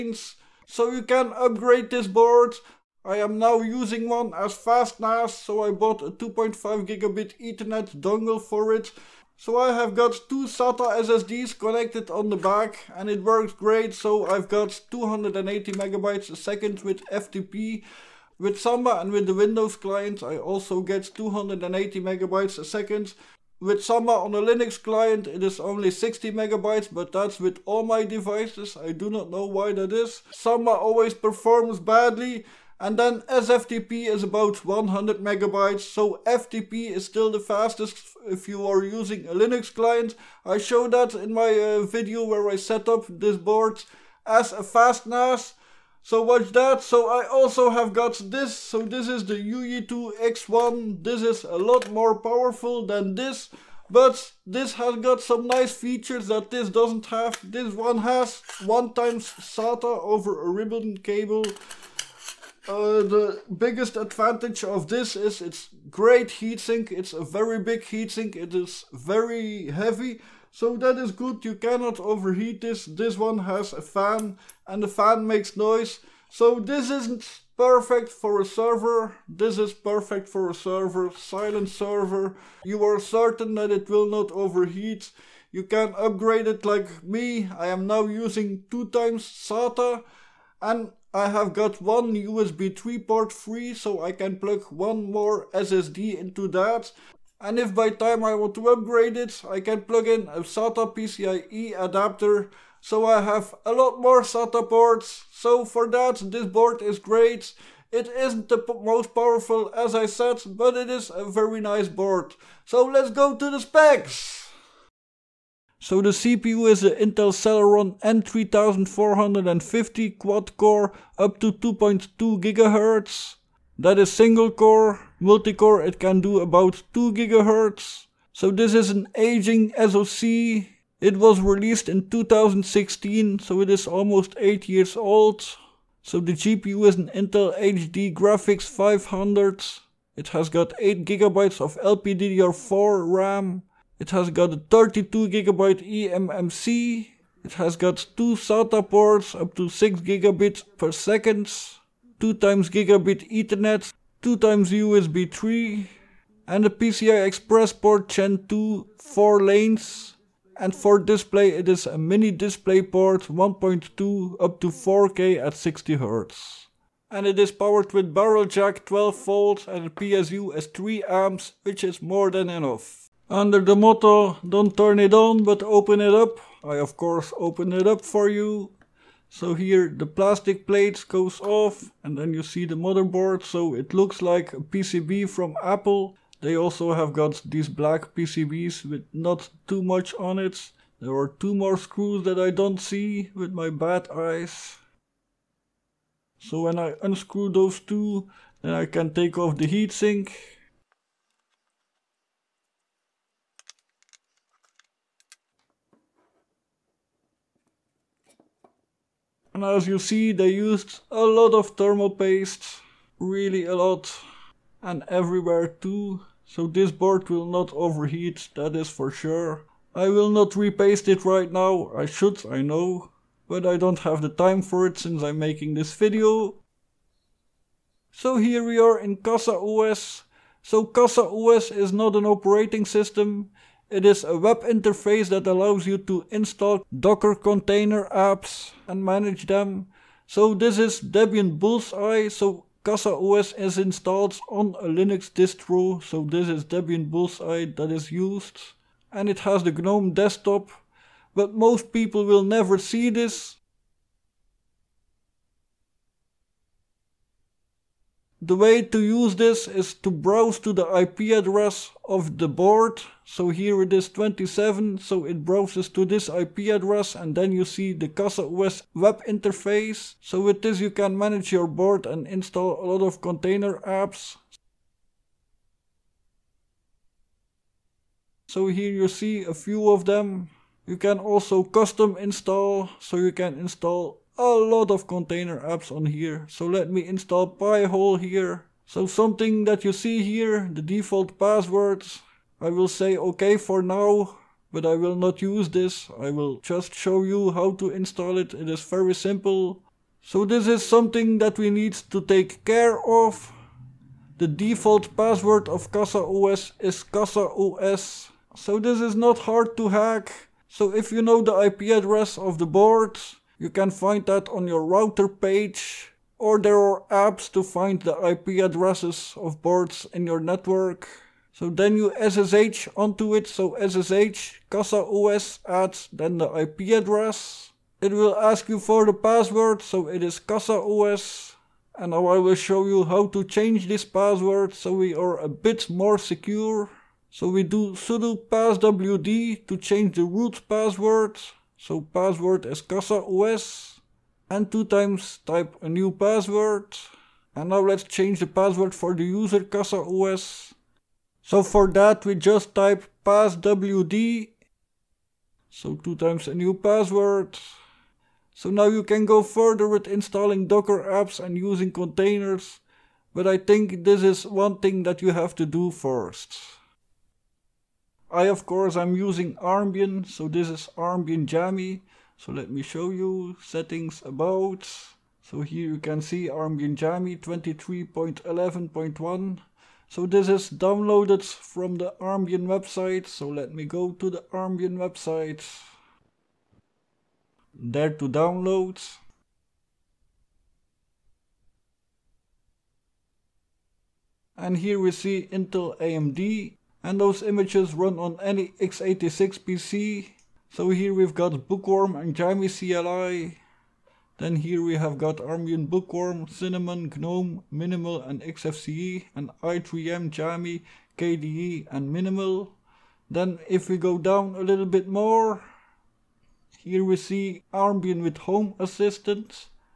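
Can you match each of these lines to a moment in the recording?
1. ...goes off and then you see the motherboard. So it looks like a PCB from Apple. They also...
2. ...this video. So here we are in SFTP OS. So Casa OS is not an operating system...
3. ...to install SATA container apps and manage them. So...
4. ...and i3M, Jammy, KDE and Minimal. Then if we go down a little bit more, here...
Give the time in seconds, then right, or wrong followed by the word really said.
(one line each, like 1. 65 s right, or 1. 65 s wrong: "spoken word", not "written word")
1. 181 s right
2. 225 s wrong: "Casa", not "SFTP"
3. 235 s wrong: "Docker", not "SATA"
4. 409 s right.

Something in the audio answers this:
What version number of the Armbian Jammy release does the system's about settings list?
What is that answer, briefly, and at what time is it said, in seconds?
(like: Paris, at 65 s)
23.11.1, at 377 s.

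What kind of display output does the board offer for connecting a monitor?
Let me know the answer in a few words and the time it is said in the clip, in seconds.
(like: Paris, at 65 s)
mini DisplayPort 1.2, at 161 s.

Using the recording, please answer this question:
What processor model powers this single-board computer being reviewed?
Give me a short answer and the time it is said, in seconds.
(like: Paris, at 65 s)
Intel Celeron N3450, at 116 s.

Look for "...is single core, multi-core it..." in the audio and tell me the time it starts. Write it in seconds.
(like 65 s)
123 s.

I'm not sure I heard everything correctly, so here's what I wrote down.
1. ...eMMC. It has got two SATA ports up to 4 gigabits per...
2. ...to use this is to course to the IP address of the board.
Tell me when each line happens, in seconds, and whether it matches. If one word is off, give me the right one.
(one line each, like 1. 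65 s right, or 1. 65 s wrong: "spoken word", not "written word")
1. 145 s wrong: "6", not "4"
2. 258 s wrong: "browse", not "course".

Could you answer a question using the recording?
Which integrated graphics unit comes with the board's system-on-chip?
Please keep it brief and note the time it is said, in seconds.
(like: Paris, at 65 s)
Intel HD Graphics 500, at 137 s.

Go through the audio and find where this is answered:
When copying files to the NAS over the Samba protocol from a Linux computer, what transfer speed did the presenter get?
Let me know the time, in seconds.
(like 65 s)
25 s.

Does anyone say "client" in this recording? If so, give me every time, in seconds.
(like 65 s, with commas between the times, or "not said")
19 s, 24 s, 39 s.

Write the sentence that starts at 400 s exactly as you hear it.
So here we've got Bookworm and Jammy CLI.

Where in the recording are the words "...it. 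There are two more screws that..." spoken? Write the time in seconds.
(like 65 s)
190 s.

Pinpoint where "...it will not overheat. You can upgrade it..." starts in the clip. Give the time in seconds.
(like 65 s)
83 s.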